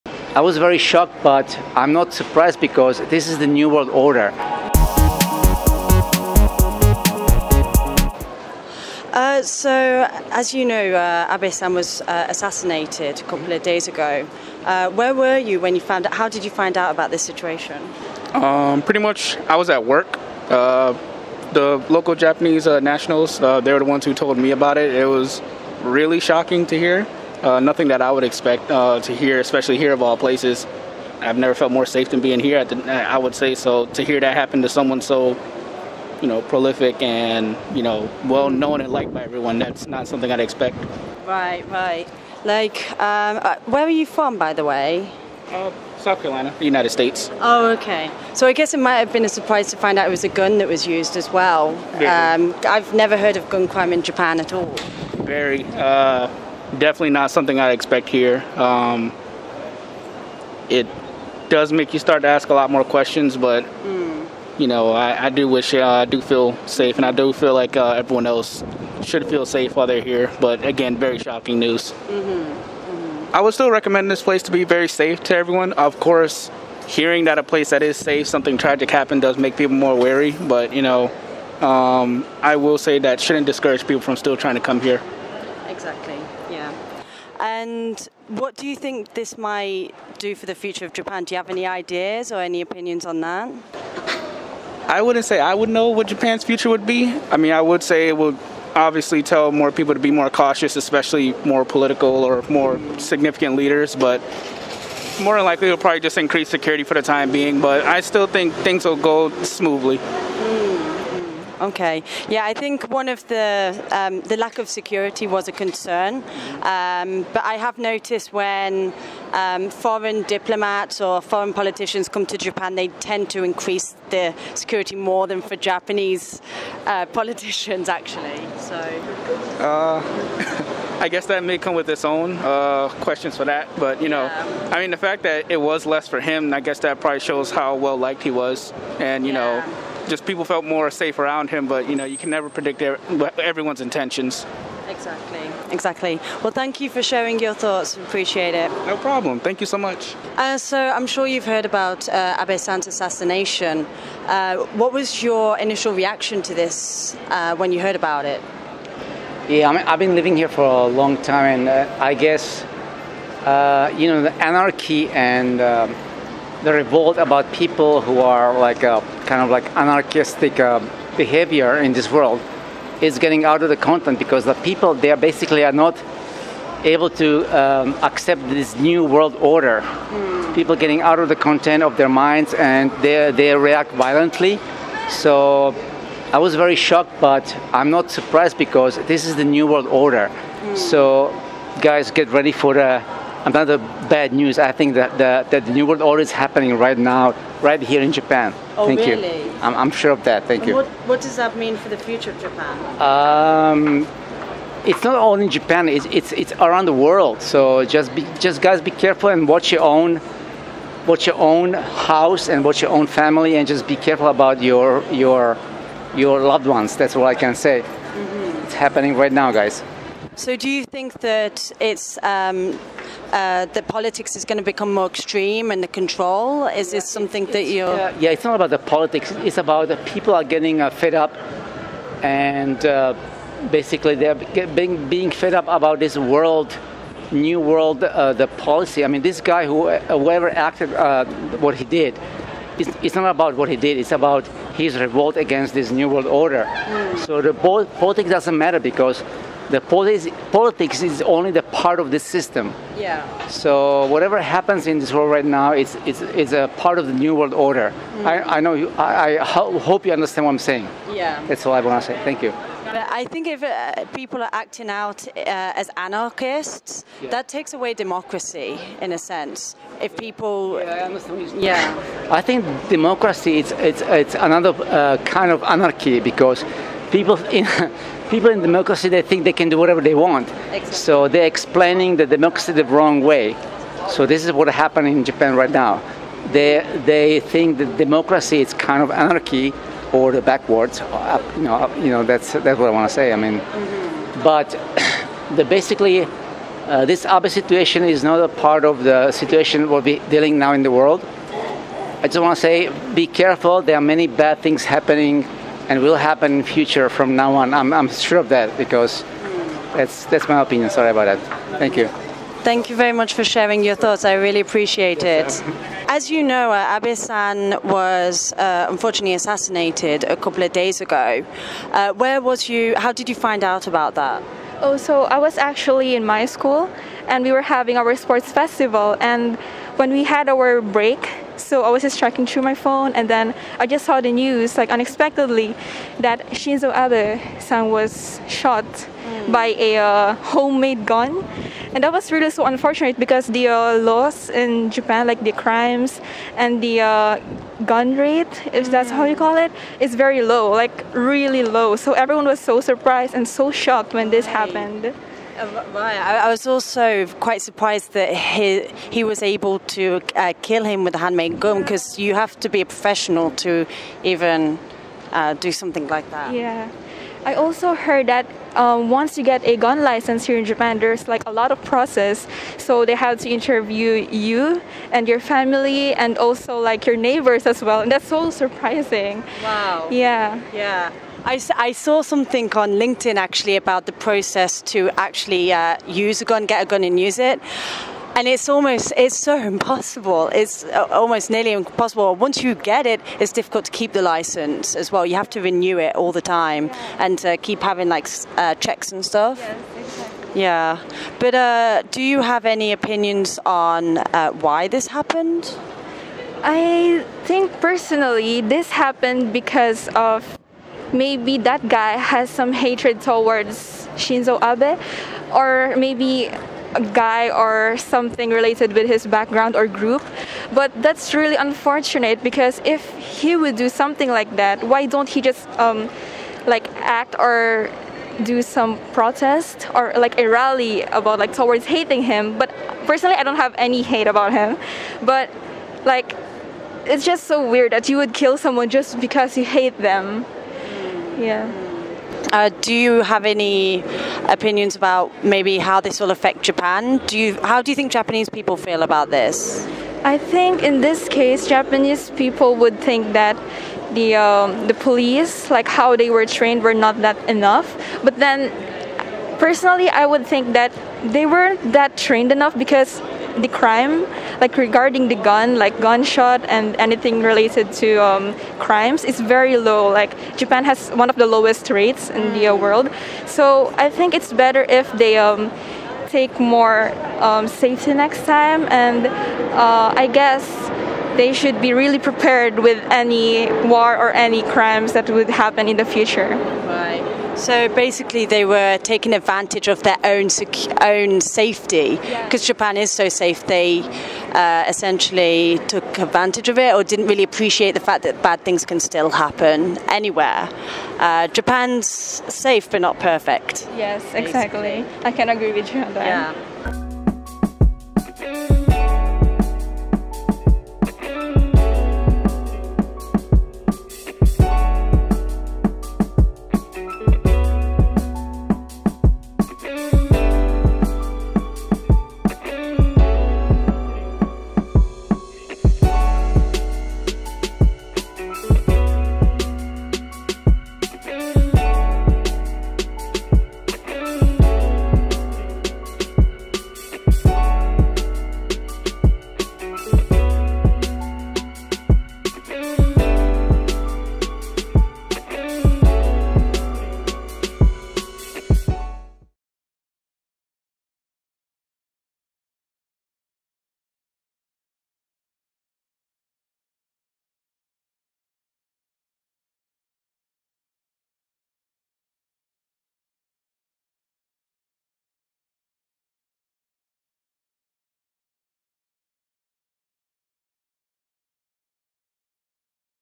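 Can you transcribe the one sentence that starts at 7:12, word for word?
But personally, I don't have any hate about him.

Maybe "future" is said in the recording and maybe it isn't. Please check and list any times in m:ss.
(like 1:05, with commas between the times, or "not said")
1:30, 1:36, 3:21, 5:06, 8:06.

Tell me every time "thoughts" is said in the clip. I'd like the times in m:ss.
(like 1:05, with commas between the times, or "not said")
2:27, 5:13.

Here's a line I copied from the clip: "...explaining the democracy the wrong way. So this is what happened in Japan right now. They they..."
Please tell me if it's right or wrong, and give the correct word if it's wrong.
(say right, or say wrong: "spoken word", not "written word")
right.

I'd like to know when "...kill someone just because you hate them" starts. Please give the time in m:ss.
7:18.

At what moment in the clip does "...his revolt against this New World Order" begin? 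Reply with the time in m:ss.
4:04.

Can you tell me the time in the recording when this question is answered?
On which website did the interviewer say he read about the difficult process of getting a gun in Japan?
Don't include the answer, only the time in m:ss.
6:22.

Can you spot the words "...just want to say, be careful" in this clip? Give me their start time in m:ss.
5:02.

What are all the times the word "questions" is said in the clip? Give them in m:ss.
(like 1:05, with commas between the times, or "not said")
1:02, 2:13.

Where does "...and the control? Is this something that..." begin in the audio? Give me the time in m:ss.
3:45.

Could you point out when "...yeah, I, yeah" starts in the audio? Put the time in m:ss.
4:30.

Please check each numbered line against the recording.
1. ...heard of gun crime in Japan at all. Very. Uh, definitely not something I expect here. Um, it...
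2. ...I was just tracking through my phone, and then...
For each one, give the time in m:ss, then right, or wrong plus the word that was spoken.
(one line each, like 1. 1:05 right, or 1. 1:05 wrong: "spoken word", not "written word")
1. 0:53 right
2. 5:31 right.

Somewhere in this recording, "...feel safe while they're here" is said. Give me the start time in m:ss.
1:09.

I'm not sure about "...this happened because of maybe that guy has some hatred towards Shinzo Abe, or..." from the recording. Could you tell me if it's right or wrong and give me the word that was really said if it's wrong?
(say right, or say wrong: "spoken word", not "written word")
right.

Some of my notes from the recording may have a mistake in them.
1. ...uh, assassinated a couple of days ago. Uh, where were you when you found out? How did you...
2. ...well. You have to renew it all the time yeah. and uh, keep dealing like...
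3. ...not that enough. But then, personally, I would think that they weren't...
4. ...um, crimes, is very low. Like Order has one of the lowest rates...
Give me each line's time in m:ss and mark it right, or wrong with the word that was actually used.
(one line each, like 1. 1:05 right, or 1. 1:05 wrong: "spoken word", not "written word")
1. 0:12 right
2. 6:35 wrong: "having", not "dealing"
3. 7:36 right
4. 7:48 wrong: "Japan", not "Order".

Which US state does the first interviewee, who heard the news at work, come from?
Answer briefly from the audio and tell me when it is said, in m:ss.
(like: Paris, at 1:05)
South Carolina, at 0:45.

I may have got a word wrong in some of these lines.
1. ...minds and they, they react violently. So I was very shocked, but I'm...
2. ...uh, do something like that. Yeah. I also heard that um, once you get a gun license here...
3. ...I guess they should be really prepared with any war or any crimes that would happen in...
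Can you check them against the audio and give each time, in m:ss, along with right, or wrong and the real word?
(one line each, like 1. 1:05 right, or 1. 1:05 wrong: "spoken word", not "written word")
1. 3:02 right
2. 6:05 right
3. 8:00 right.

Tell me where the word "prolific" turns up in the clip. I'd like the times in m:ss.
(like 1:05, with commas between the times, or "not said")
0:36.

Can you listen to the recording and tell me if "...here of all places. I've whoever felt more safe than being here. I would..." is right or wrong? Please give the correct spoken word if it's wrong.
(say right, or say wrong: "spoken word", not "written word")
wrong: "never", not "whoever".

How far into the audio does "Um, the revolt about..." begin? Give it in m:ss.
2:45.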